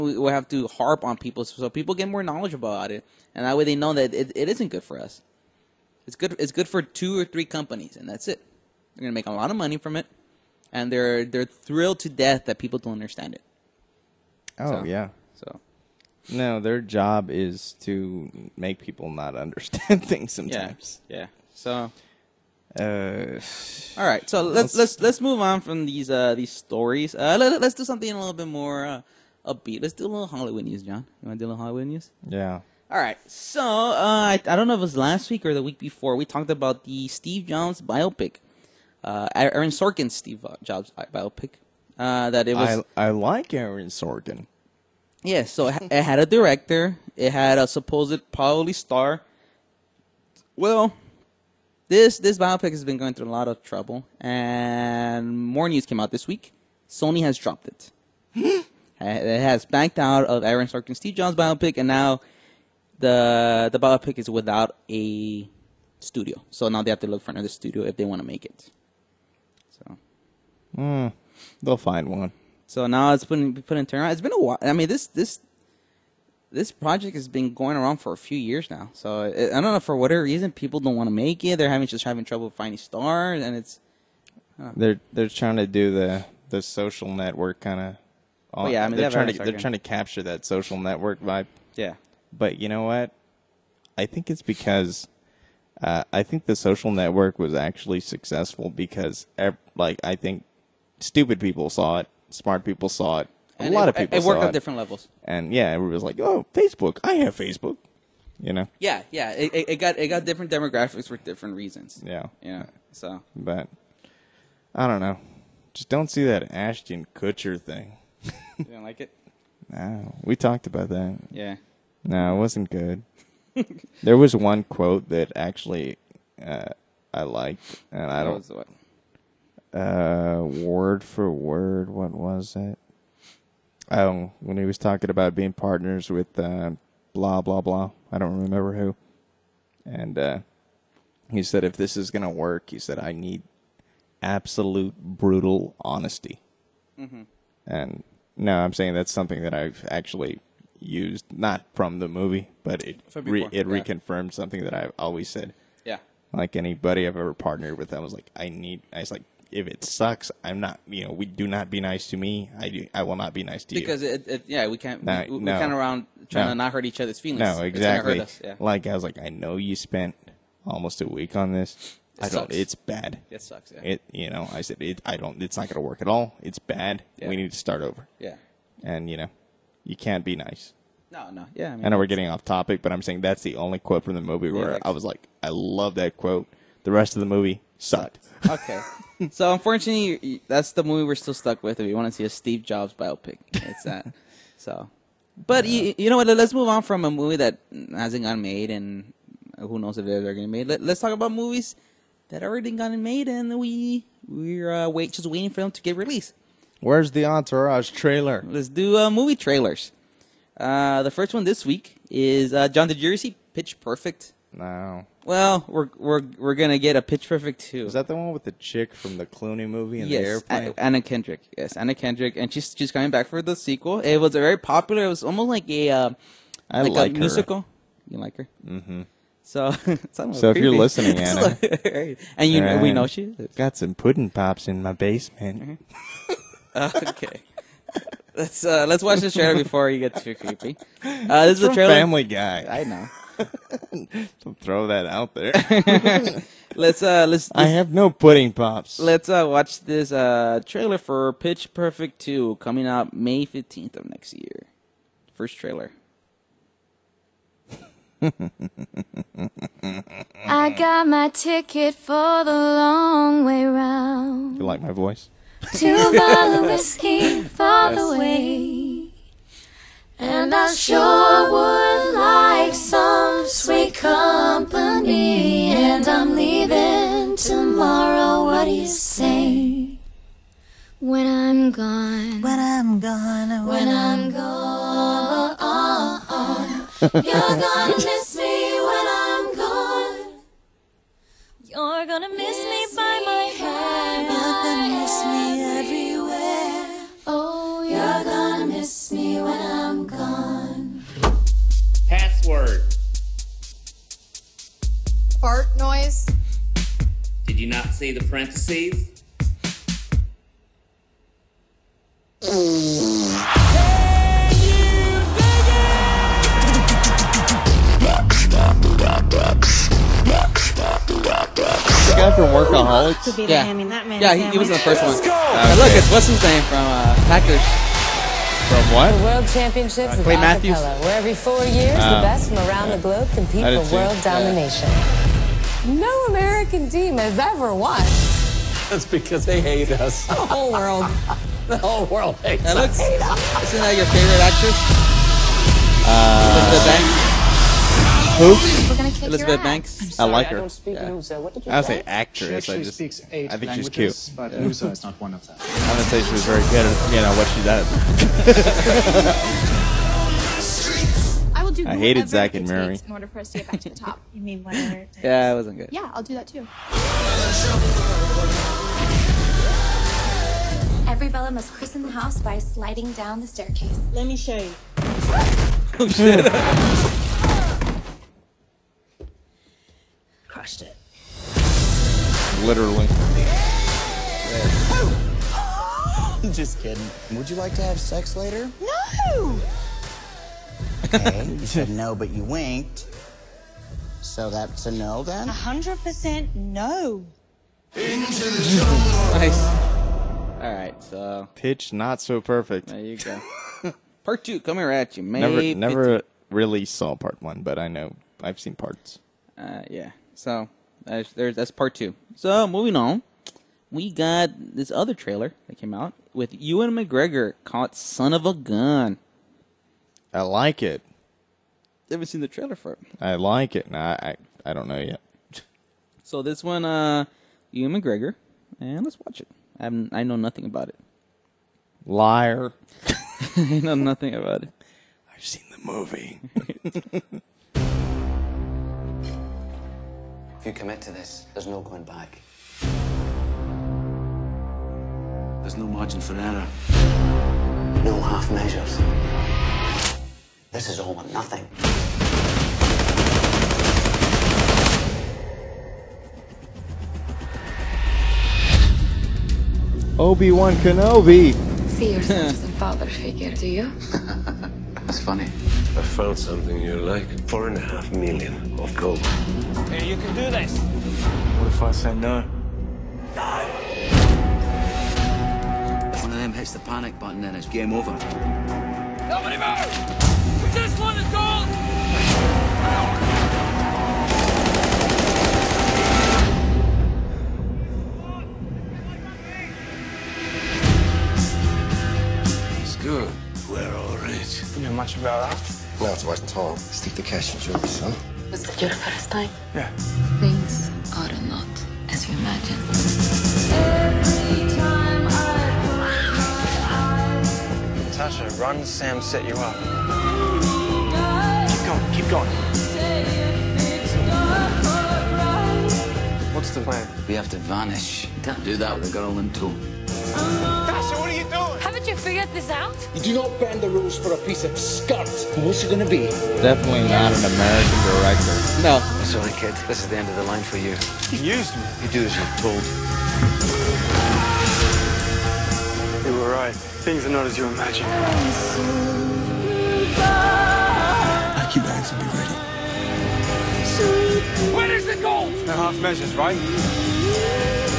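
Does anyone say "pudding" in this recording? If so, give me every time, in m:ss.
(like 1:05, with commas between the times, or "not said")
3:53, 4:08.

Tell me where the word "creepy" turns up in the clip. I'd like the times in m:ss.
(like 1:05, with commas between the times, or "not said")
3:49, 4:00.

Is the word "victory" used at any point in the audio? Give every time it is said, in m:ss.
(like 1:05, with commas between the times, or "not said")
not said.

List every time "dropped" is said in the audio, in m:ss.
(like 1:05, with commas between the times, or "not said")
0:57.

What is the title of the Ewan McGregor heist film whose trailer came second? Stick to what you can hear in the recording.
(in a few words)
Son of a Gun.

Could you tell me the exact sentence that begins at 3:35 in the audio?
Well, we're we're we're gonna get a Pitch Perfect two.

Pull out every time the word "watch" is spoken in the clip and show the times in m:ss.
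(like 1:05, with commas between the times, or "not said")
3:59, 4:09, 7:09.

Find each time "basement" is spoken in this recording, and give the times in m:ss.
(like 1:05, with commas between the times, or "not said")
3:54.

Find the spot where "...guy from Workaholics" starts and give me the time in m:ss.
5:22.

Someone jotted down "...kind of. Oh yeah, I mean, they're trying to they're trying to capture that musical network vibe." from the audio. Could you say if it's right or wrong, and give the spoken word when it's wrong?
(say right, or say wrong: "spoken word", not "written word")
wrong: "social", not "musical".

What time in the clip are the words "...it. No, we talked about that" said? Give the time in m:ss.
1:59.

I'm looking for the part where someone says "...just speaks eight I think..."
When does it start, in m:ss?
5:52.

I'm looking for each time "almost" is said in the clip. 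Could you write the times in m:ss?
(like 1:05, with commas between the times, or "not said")
2:50, 3:45.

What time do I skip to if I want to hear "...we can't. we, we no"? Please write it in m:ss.
2:44.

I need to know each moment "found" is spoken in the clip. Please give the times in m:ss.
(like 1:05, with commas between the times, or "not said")
7:46.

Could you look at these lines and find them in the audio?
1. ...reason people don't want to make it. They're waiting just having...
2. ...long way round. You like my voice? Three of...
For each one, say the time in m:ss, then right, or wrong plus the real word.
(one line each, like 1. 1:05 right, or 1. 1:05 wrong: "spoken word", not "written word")
1. 1:20 wrong: "having", not "waiting"
2. 4:22 wrong: "Two", not "Three".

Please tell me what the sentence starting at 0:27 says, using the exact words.
Uh, let, us do something a little bit more uh, upbeat.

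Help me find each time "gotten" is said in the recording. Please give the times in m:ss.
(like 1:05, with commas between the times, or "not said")
3:18, 3:22.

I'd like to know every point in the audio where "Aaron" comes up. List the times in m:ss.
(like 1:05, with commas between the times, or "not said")
0:39, 0:43, 1:00.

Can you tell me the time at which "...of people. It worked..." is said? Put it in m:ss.
1:43.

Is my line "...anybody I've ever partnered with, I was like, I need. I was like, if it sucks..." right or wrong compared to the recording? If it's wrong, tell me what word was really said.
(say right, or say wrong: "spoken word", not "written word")
right.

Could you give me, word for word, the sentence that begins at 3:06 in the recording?
The rest of the movie sucked.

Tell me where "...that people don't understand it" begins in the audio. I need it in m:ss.
0:12.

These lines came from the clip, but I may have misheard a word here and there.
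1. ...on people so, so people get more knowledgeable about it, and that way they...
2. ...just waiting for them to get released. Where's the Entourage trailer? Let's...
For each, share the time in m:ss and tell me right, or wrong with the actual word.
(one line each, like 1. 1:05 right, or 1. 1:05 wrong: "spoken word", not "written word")
1. 0:01 right
2. 3:25 right.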